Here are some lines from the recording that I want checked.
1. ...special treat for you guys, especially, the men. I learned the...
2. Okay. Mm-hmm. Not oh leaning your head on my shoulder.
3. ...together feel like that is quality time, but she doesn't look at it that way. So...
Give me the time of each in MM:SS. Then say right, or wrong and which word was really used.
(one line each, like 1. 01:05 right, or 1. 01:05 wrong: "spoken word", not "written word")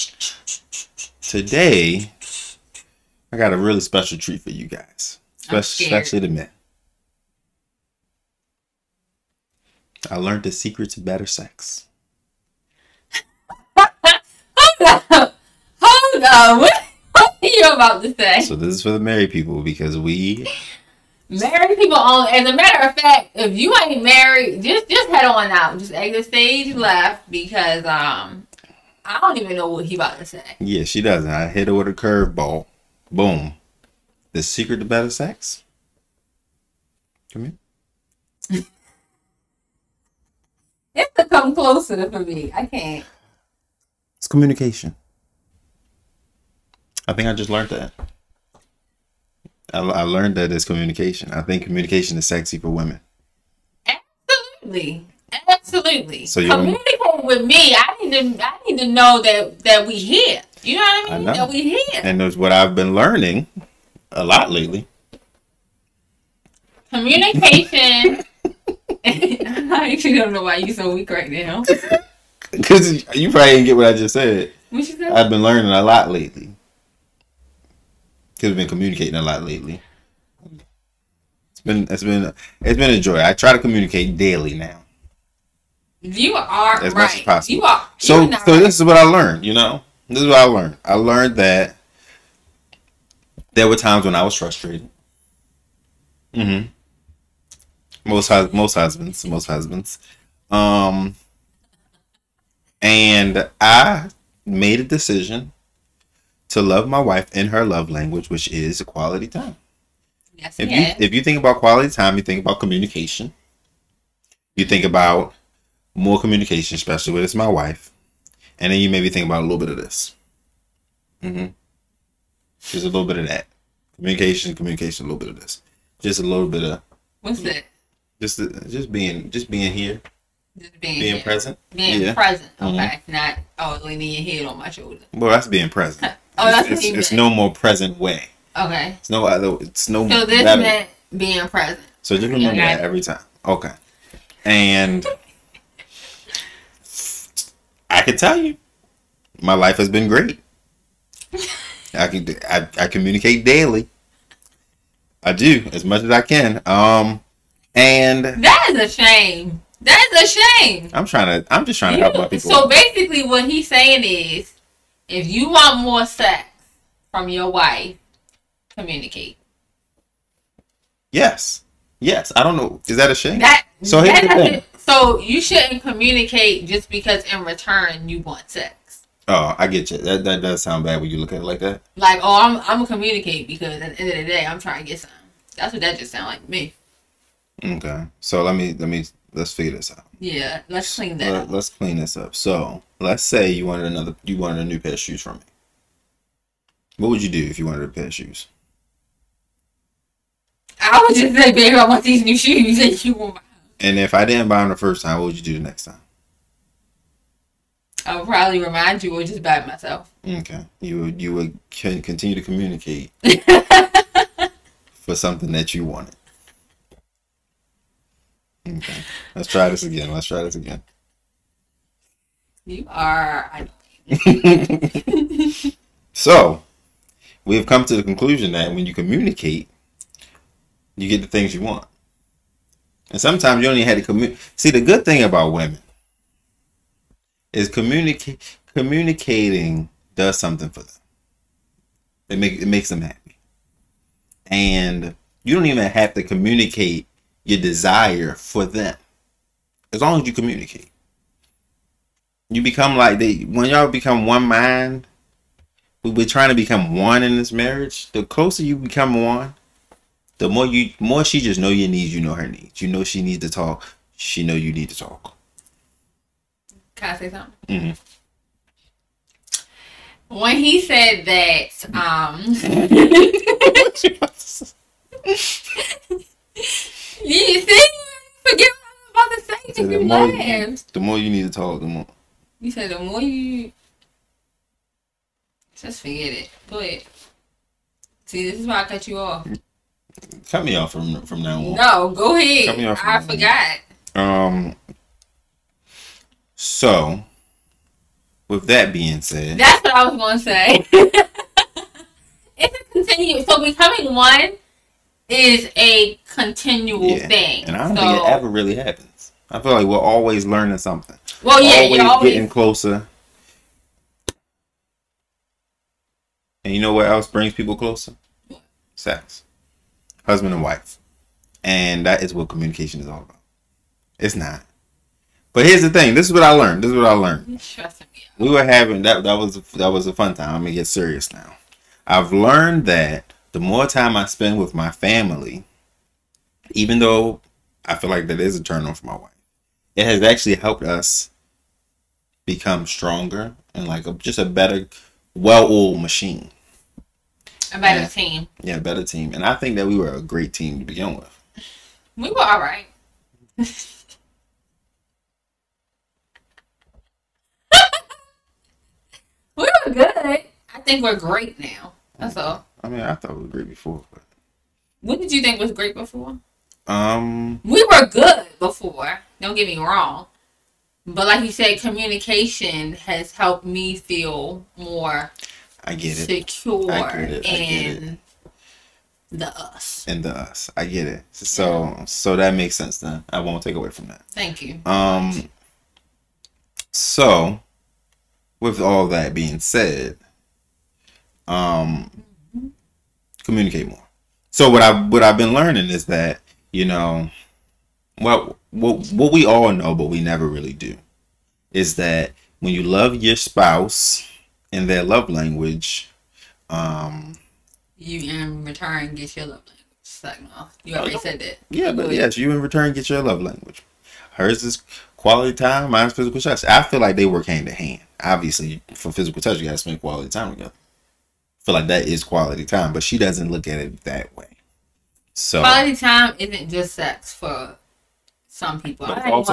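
1. 00:03 right
2. 02:12 right
3. 07:00 right.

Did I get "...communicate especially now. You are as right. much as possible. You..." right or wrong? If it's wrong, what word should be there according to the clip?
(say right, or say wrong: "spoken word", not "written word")
wrong: "daily", not "especially".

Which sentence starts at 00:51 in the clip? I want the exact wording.
I think communication is sexy for women.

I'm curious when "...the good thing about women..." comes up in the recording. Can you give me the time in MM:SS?
03:54.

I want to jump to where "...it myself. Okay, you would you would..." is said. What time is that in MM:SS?
03:29.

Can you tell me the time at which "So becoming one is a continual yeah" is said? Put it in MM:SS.
05:03.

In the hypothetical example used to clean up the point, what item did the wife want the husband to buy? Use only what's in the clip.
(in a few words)
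A new pair of shoes.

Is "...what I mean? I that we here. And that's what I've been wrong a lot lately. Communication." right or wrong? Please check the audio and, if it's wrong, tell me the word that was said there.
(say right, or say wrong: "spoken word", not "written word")
wrong: "learning", not "wrong".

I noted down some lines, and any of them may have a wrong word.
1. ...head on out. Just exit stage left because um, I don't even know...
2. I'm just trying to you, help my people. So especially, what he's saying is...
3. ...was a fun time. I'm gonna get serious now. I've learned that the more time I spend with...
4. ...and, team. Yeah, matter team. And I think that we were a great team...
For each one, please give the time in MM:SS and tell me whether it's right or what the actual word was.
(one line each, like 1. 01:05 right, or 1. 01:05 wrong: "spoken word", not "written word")
1. 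00:25 right
2. 02:41 wrong: "basically", not "especially"
3. 05:29 right
4. 05:48 wrong: "better", not "matter".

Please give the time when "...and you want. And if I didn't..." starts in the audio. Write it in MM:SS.
03:22.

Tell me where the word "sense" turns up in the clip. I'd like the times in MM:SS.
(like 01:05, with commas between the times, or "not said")
06:22.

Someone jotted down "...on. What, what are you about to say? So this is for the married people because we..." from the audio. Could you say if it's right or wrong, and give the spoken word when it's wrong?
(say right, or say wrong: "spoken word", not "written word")
right.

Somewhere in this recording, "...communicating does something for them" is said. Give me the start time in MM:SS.
03:58.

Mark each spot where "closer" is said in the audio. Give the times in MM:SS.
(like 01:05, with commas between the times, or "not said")
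00:41, 04:18, 05:12, 05:17.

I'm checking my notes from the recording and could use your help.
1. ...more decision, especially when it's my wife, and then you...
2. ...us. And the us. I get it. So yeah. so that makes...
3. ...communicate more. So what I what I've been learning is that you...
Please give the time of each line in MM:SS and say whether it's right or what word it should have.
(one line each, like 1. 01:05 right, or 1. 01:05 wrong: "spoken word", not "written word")
1. 01:55 wrong: "communication", not "decision"
2. 06:19 right
3. 06:33 right.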